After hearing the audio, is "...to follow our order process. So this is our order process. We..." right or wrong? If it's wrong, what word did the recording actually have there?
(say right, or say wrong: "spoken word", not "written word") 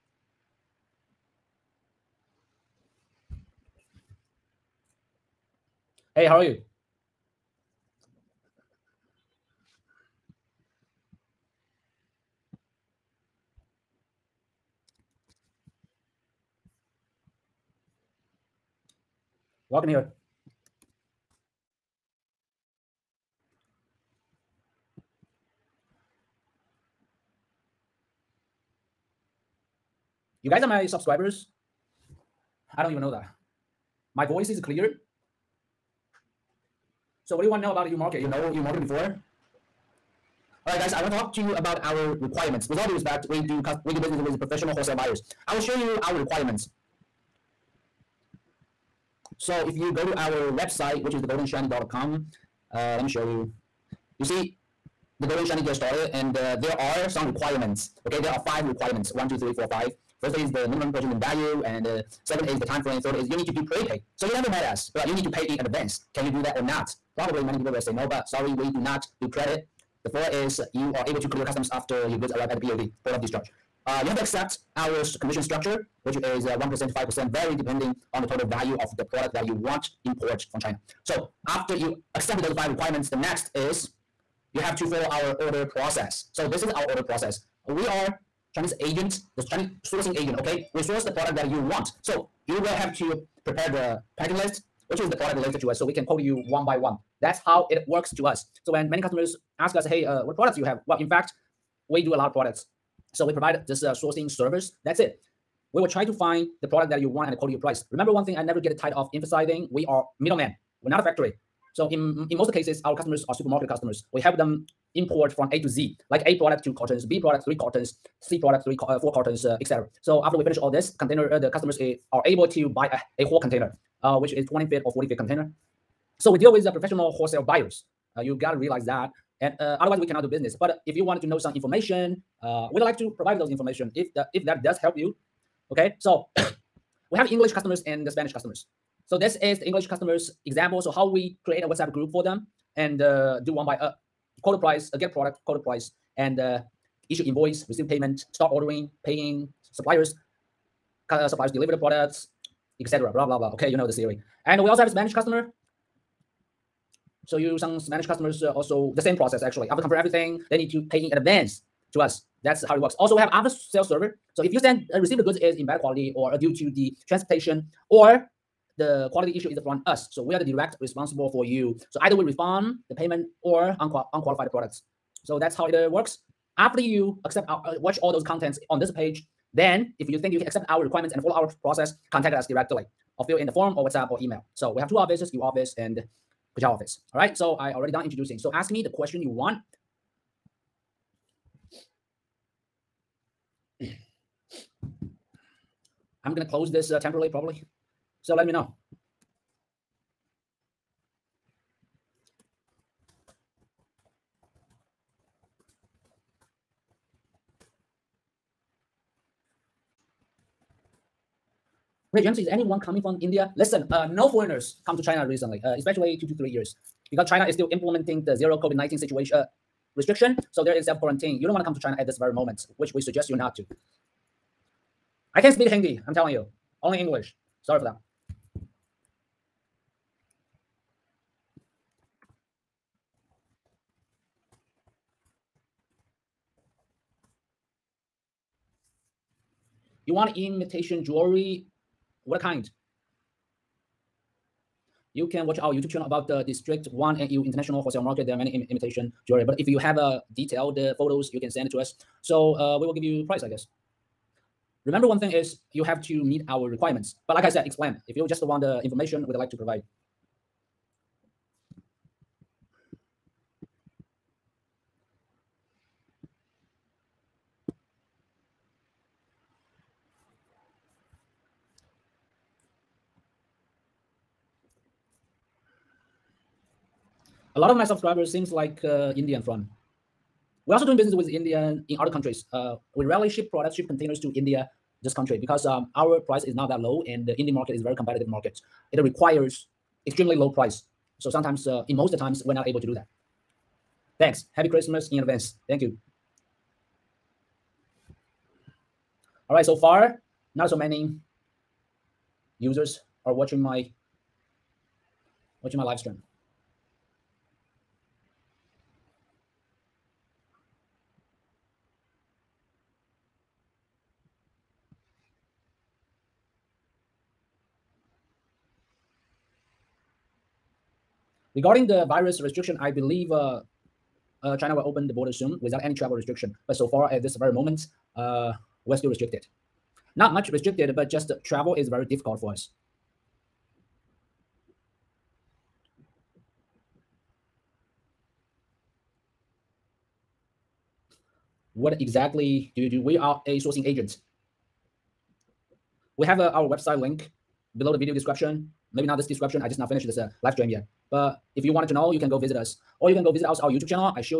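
right.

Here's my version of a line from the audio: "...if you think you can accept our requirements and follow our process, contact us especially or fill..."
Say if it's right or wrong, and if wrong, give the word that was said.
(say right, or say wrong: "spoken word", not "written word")
wrong: "directly", not "especially".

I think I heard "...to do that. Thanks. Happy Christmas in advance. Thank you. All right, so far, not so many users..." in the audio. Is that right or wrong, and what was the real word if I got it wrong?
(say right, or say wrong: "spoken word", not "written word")
right.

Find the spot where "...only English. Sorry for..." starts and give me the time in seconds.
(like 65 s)
226 s.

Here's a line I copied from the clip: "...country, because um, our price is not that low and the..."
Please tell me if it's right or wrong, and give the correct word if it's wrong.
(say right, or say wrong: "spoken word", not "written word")
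right.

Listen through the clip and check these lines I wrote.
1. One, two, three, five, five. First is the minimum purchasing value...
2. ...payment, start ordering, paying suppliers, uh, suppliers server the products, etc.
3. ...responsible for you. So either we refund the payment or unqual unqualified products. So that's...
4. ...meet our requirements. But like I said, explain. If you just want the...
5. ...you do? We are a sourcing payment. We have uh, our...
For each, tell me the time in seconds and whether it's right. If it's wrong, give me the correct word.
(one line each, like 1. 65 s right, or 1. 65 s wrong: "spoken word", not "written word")
1. 59 s wrong: "four", not "five"
2. 147 s wrong: "deliver", not "server"
3. 170 s right
4. 256 s right
5. 342 s wrong: "agent", not "payment".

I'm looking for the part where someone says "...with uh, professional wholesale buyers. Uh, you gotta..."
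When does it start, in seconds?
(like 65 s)
126 s.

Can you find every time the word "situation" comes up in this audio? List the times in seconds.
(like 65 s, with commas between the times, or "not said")
218 s.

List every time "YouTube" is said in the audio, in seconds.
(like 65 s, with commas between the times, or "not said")
245 s, 353 s.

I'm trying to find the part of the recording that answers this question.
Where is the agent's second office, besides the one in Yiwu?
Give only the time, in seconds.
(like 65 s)
186 s.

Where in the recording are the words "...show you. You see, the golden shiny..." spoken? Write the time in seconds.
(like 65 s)
53 s.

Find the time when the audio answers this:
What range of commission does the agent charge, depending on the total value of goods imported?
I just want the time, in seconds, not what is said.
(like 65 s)
76 s.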